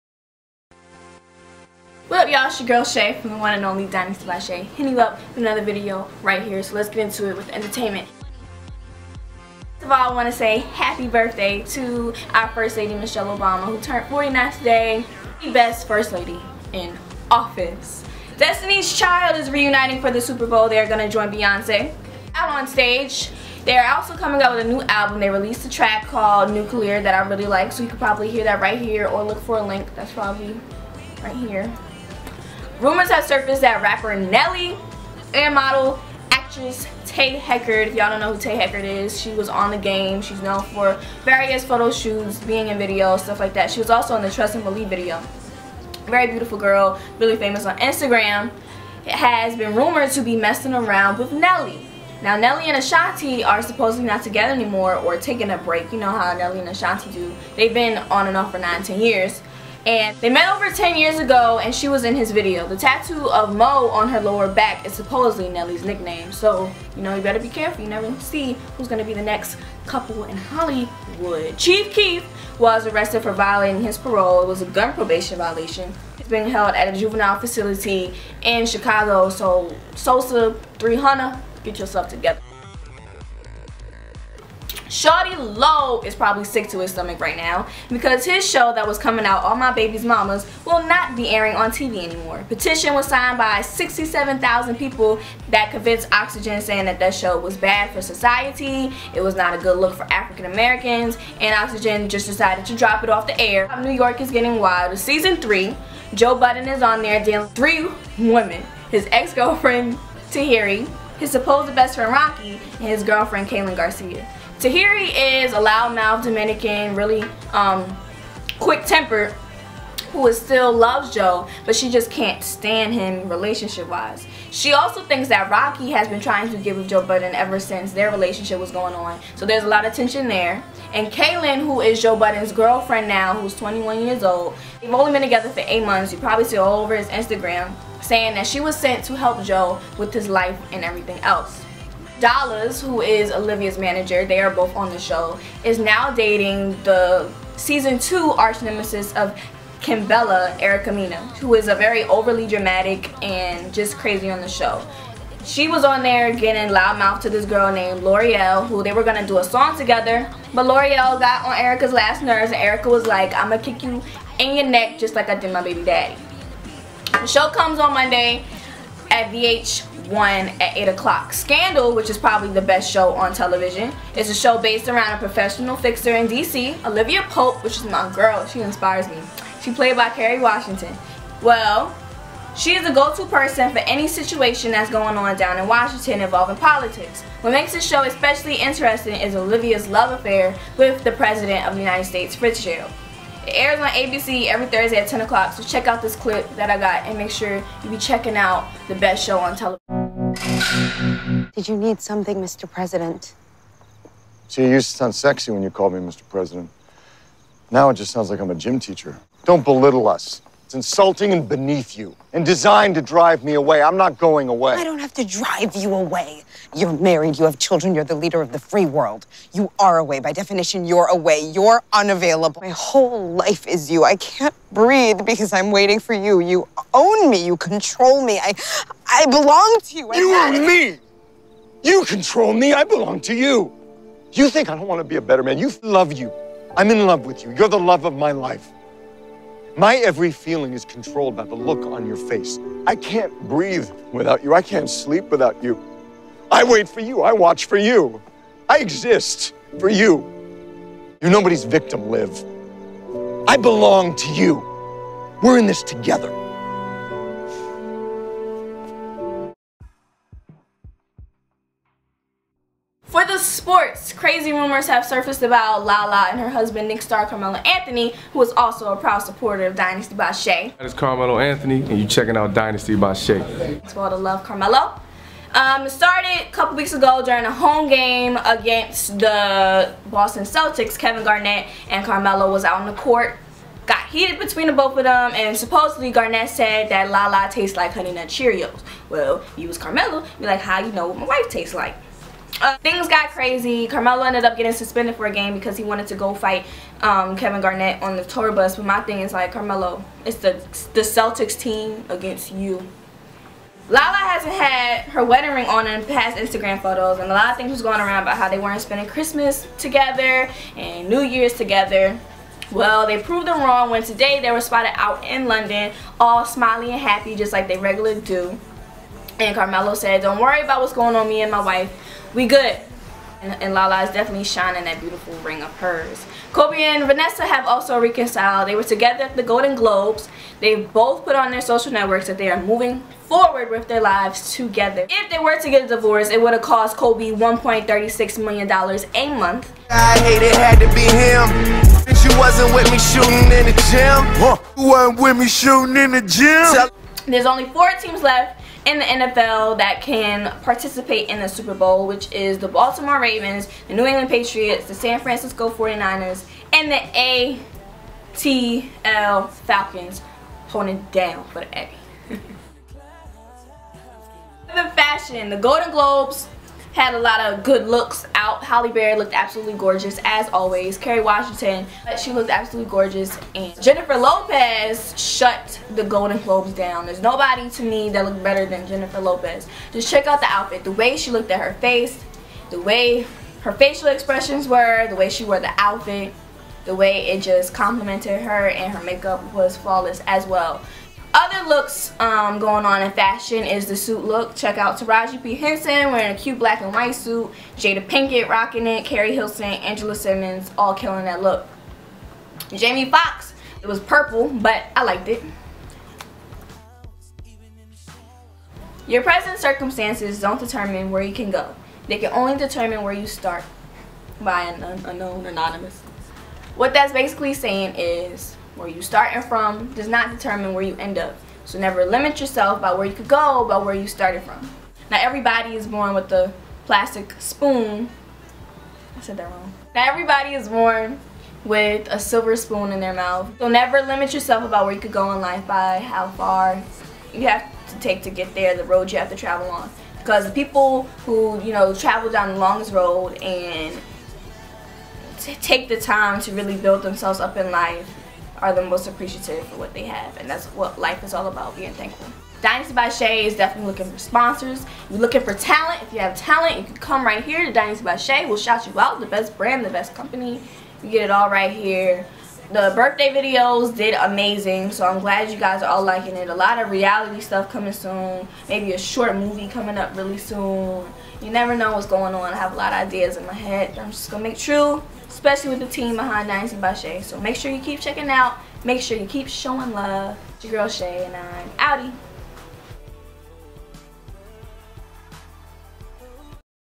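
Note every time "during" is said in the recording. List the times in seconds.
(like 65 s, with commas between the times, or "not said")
277 s.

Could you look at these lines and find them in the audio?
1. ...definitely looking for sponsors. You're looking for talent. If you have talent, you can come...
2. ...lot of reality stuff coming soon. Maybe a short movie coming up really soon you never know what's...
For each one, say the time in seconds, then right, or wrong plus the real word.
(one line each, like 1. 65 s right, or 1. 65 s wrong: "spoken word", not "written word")
1. 453 s right
2. 466 s right.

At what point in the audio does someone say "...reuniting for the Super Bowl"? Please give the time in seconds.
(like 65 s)
19 s.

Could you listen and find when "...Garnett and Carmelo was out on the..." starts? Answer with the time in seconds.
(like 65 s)
281 s.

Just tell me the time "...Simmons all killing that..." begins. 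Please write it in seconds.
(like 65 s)
400 s.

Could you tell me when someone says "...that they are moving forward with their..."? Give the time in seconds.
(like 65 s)
332 s.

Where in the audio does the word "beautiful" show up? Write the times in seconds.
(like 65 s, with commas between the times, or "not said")
46 s, 325 s.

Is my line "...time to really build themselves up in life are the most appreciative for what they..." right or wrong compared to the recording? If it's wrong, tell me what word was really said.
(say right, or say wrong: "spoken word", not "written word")
right.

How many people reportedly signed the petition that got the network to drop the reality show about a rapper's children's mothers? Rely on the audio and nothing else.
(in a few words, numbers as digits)
67,000.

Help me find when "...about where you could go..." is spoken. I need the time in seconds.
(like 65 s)
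434 s.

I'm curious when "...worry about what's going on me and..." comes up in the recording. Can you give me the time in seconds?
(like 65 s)
320 s.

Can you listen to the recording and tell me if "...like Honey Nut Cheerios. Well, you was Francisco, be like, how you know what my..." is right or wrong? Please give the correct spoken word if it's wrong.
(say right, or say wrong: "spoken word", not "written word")
wrong: "Carmelo", not "Francisco".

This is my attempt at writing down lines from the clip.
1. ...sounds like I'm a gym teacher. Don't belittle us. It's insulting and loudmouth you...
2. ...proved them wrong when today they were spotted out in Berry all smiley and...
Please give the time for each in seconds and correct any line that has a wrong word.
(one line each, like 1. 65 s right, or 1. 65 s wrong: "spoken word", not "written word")
1. 208 s wrong: "beneath", not "loudmouth"
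2. 313 s wrong: "London", not "Berry".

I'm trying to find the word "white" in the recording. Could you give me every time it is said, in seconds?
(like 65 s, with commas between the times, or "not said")
396 s.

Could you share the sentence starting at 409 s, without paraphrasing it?
Your present circumstances don't determine where you can go.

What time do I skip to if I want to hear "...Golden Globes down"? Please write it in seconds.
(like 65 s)
376 s.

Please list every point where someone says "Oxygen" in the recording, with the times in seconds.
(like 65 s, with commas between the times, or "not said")
96 s, 101 s.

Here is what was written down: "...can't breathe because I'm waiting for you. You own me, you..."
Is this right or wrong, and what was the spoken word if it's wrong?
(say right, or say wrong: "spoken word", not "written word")
right.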